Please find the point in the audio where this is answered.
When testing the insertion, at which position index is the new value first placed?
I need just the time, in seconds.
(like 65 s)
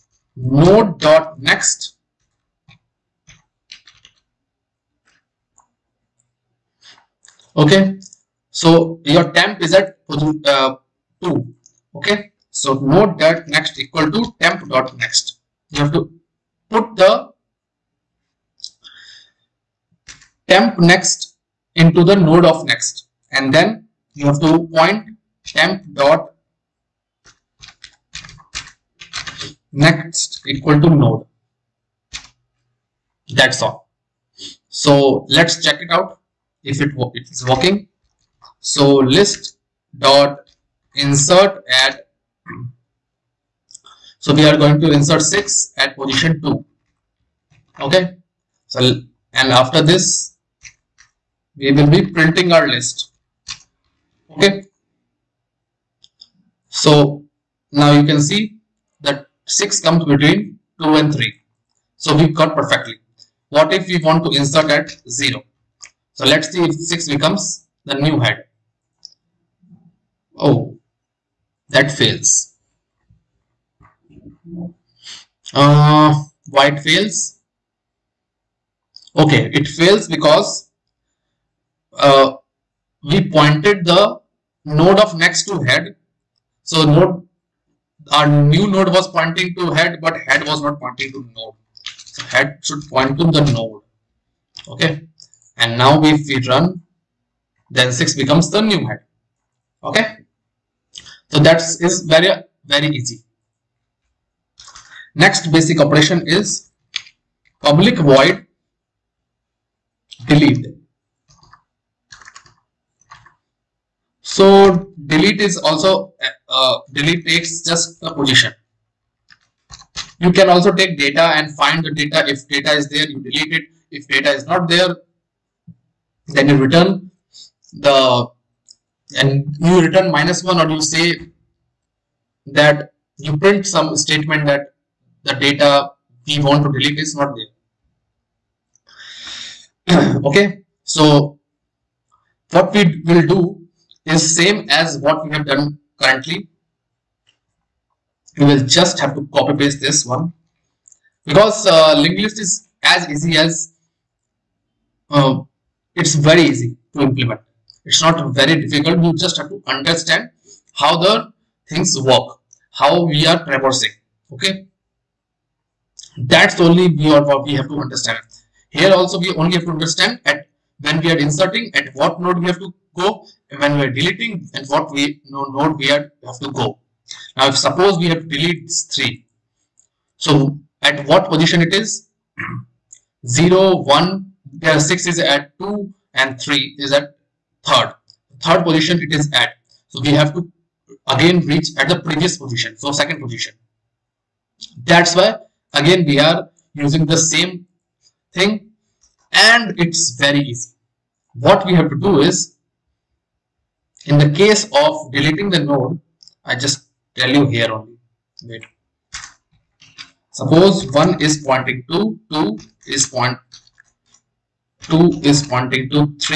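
45 s.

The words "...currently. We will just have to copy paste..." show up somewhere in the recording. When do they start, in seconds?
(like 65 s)
145 s.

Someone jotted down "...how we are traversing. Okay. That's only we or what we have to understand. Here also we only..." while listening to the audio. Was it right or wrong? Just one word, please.
right.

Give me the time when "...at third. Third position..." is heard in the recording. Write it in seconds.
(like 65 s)
186 s.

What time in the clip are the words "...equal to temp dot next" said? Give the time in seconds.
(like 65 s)
13 s.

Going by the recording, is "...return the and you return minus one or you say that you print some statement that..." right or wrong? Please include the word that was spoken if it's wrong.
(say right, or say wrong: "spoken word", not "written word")
right.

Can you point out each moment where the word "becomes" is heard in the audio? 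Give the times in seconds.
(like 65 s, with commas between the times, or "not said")
67 s, 98 s.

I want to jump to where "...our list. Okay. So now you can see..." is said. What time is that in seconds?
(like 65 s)
52 s.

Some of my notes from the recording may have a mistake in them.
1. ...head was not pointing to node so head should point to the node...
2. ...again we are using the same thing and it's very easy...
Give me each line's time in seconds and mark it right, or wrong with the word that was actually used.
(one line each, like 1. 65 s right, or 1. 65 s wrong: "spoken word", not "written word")
1. 90 s right
2. 195 s right.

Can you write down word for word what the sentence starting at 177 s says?
Now, if suppose we have to delete three, so at what position it is?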